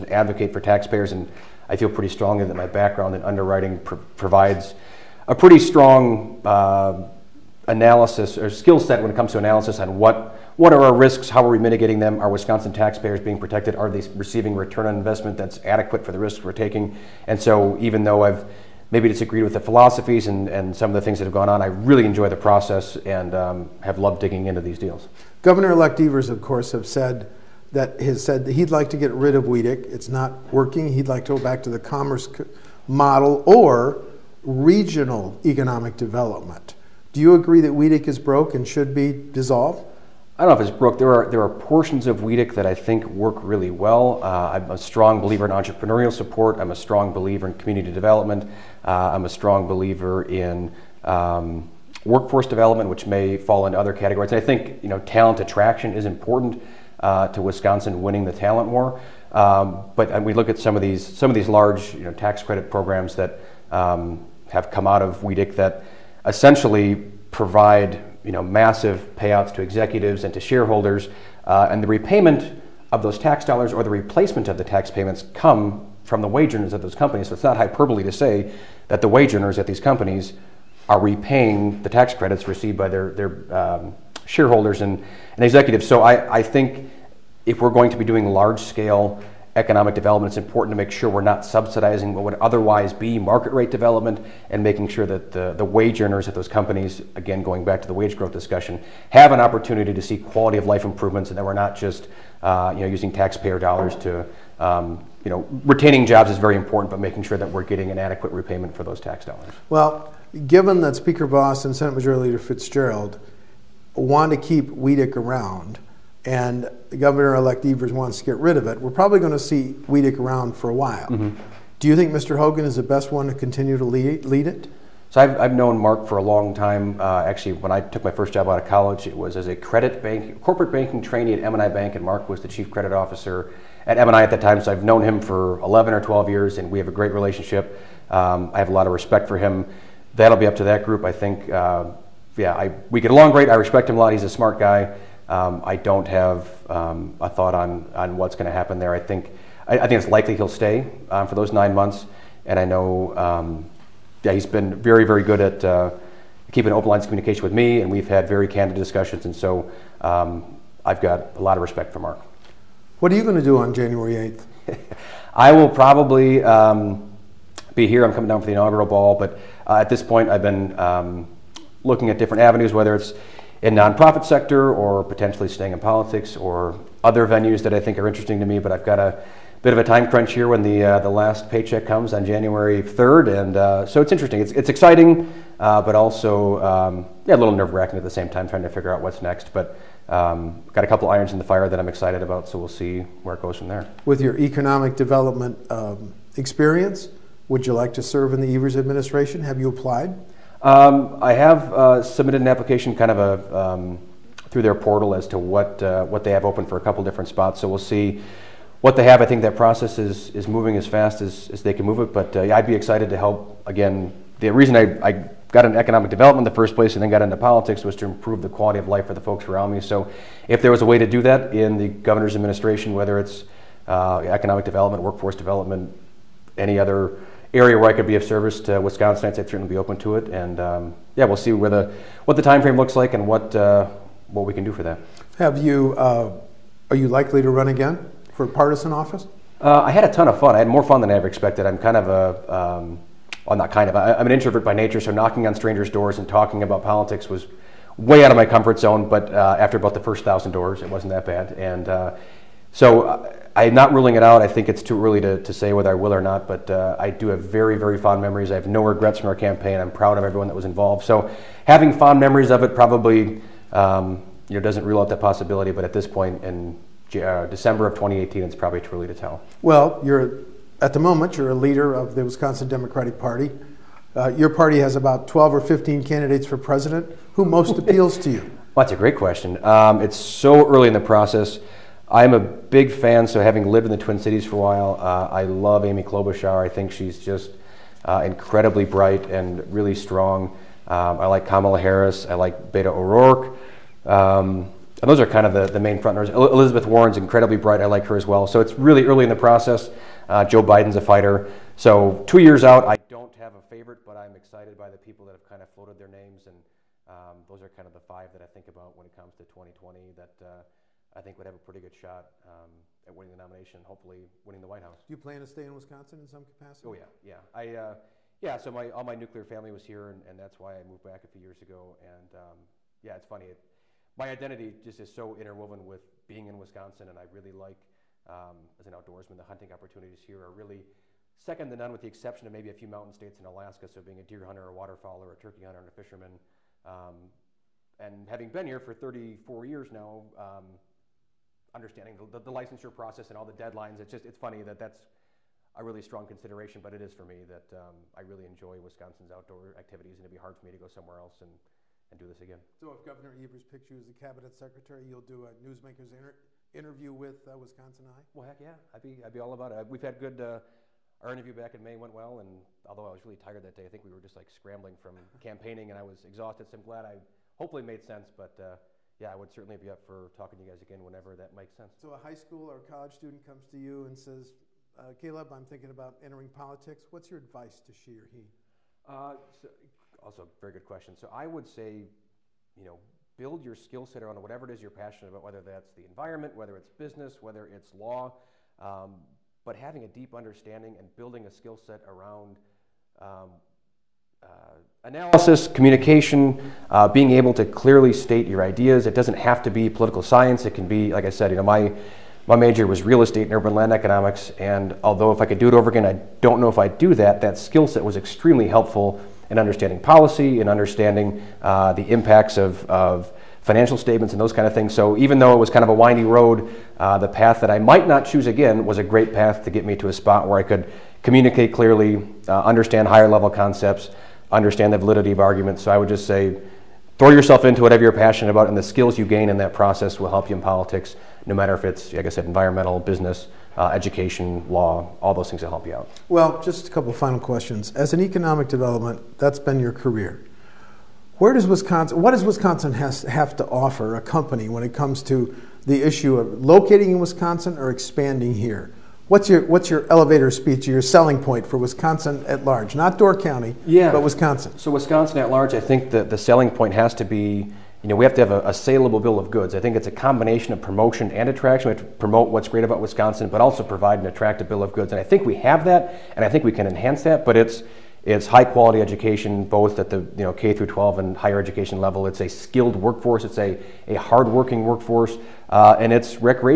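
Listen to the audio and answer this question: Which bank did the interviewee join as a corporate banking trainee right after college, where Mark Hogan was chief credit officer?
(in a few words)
M&I Bank.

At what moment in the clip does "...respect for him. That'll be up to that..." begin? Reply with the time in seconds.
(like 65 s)
138 s.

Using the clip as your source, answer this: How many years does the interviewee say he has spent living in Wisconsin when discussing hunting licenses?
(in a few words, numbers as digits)
34.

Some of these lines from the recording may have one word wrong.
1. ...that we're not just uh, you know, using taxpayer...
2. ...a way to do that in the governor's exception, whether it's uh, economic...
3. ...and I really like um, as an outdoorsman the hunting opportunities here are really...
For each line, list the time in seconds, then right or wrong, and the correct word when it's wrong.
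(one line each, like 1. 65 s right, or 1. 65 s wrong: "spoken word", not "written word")
1. 101 s right
2. 220 s wrong: "administration", not "exception"
3. 327 s right.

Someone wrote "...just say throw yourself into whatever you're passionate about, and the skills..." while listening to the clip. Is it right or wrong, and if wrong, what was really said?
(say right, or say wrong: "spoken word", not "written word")
right.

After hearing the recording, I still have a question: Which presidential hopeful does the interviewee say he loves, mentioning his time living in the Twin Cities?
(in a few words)
Amy Klobuchar.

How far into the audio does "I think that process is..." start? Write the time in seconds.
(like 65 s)
209 s.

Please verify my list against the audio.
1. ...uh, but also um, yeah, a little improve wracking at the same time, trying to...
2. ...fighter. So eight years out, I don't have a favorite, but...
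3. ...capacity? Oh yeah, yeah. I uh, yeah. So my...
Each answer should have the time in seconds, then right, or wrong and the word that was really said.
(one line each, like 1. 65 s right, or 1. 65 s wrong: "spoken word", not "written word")
1. 185 s wrong: "nerve", not "improve"
2. 301 s wrong: "two", not "eight"
3. 316 s right.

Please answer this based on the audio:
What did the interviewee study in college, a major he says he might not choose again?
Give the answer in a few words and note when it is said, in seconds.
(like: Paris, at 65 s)
Real estate and urban land economics, at 403 s.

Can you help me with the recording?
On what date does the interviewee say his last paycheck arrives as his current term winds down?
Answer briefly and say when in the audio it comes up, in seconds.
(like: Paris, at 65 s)
January 3rd, at 182 s.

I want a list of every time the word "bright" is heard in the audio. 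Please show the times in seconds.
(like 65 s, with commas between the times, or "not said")
288 s, 297 s.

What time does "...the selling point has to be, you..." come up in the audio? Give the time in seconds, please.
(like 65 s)
456 s.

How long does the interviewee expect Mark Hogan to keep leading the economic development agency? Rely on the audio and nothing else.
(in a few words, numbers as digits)
Nine months.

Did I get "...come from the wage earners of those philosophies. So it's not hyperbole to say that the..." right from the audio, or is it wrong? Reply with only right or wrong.
wrong.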